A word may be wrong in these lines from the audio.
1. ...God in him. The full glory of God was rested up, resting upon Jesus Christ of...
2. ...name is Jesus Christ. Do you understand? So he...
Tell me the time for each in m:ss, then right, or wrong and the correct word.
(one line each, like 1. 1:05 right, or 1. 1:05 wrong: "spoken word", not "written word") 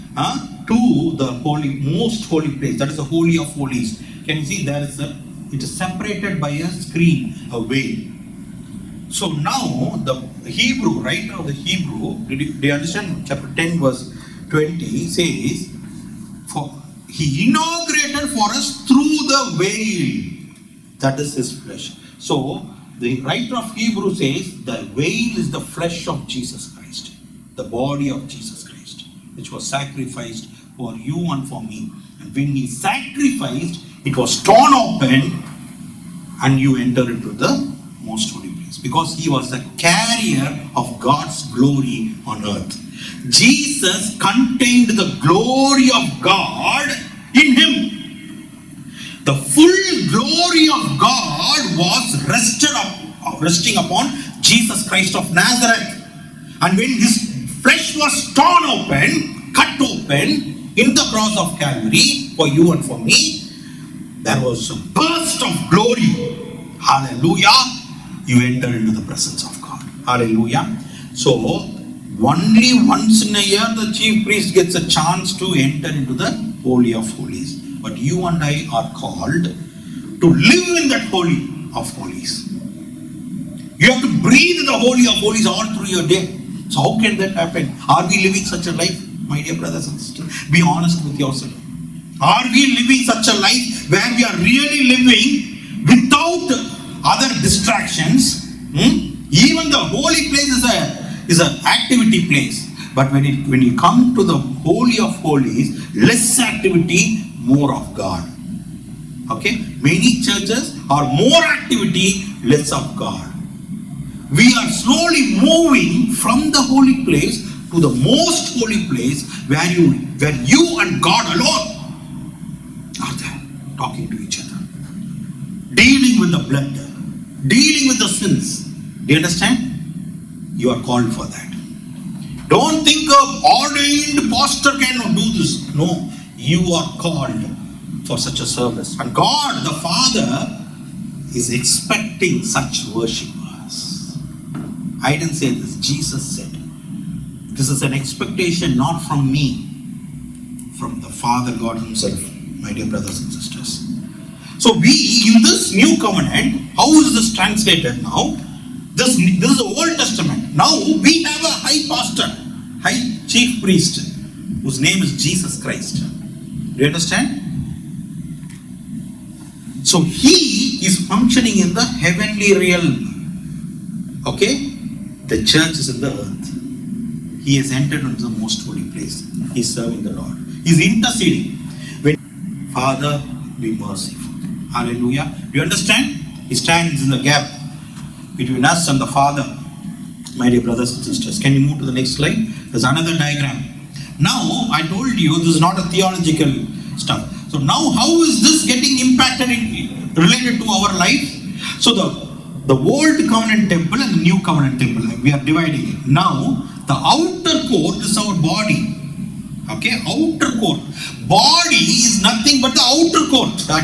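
1. 0:46 right
2. 2:44 right.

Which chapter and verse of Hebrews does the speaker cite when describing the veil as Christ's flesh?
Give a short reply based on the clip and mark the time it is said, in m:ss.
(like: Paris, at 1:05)
Chapter 10 verse 20, at 0:13.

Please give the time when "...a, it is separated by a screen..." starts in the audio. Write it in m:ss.
0:04.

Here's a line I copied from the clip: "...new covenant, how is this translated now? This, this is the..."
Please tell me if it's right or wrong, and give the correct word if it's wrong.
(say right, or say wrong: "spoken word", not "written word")
right.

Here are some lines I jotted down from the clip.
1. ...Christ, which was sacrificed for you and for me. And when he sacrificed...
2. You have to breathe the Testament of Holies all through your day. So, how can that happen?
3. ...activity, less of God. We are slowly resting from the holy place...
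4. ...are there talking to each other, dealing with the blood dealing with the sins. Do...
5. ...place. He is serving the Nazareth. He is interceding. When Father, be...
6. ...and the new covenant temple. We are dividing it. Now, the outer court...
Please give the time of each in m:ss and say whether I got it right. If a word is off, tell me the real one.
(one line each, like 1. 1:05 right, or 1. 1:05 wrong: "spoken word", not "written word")
1. 0:28 right
2. 1:23 wrong: "Holy", not "Testament"
3. 1:51 wrong: "moving", not "resting"
4. 2:03 right
5. 2:58 wrong: "Lord", not "Nazareth"
6. 3:24 right.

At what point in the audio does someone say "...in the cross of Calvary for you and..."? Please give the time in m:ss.
1:00.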